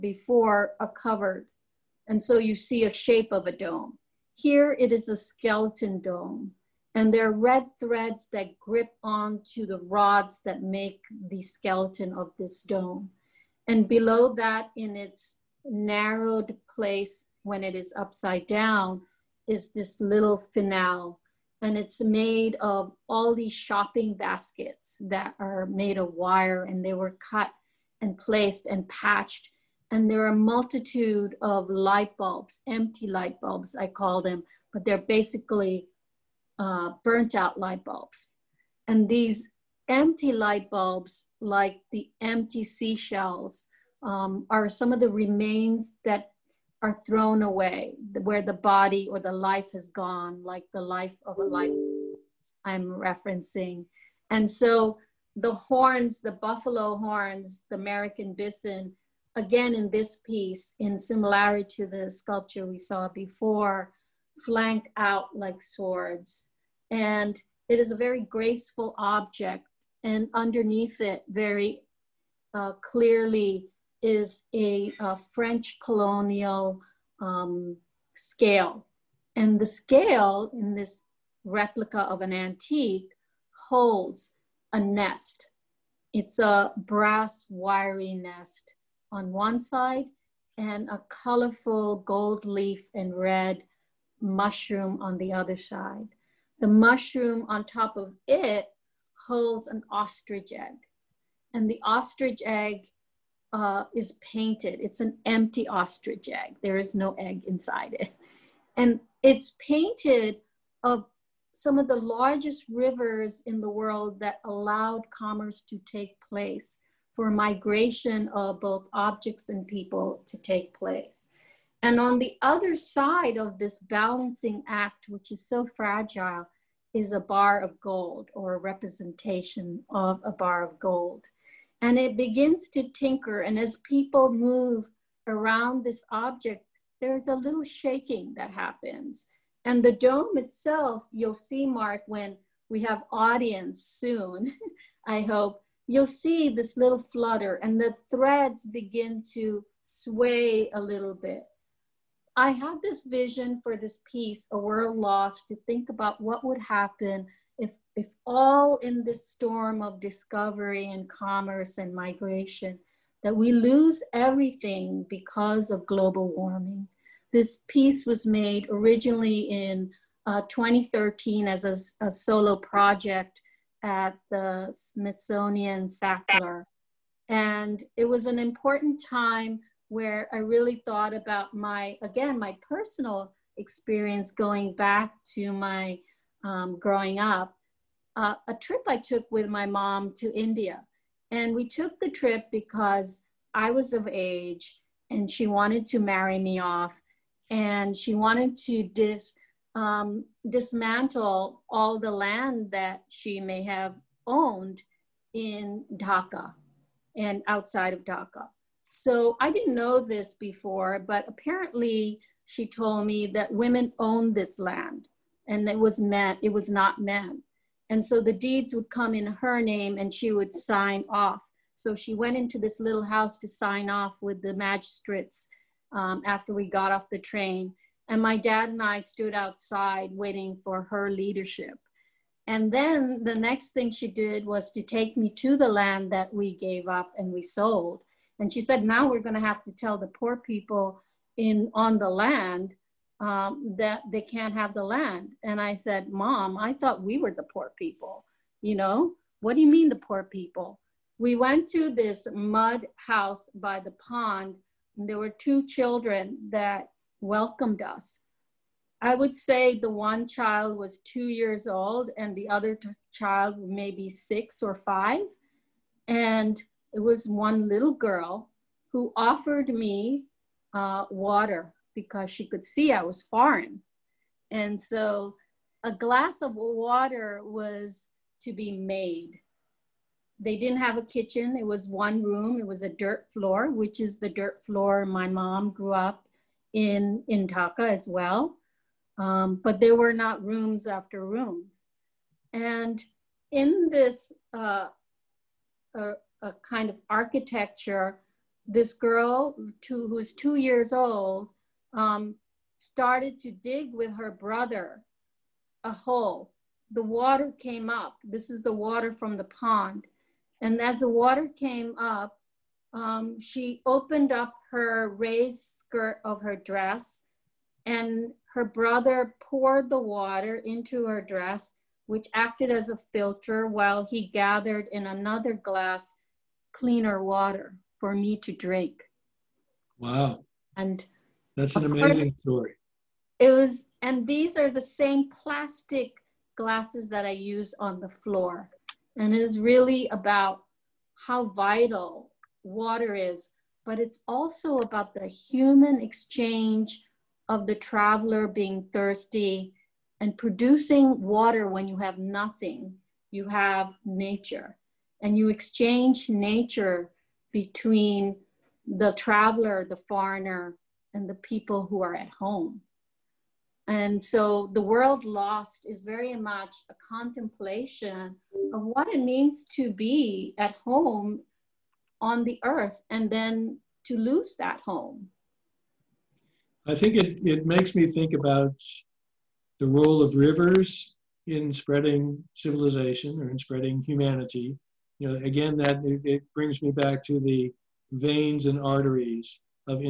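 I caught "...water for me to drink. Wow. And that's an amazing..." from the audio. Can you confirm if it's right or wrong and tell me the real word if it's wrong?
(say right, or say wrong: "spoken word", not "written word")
right.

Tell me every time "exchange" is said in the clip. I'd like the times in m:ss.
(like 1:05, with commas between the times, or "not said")
5:46, 5:55.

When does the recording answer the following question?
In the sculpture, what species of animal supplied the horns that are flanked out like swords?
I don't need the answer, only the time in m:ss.
0:57.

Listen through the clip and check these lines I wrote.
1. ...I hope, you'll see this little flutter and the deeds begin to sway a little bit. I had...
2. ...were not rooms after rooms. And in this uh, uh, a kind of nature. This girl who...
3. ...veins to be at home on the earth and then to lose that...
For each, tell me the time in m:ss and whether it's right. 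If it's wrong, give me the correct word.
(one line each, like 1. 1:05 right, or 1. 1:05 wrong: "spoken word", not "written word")
1. 2:25 wrong: "threads", not "deeds"
2. 4:49 wrong: "architecture", not "nature"
3. 6:09 wrong: "means", not "veins".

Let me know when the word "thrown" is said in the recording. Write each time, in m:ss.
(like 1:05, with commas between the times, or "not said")
0:47.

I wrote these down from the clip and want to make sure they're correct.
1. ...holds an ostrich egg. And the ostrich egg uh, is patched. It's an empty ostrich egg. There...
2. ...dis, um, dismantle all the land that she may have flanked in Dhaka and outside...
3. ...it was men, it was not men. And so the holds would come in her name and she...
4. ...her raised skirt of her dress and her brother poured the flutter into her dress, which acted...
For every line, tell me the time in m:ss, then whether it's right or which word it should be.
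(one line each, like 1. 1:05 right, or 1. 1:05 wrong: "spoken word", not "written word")
1. 1:39 wrong: "painted", not "patched"
2. 3:18 wrong: "owned", not "flanked"
3. 3:35 wrong: "deeds", not "holds"
4. 5:14 wrong: "water", not "flutter".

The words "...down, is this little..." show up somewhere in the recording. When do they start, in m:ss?
0:18.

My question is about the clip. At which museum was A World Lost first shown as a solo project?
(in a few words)
Smithsonian Sackler.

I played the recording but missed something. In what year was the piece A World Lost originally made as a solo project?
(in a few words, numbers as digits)
2013.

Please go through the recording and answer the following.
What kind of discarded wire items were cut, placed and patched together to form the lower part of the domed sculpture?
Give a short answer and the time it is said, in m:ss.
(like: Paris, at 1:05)
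Shopping baskets, at 0:23.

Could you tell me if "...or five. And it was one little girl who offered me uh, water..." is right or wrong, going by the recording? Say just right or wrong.
right.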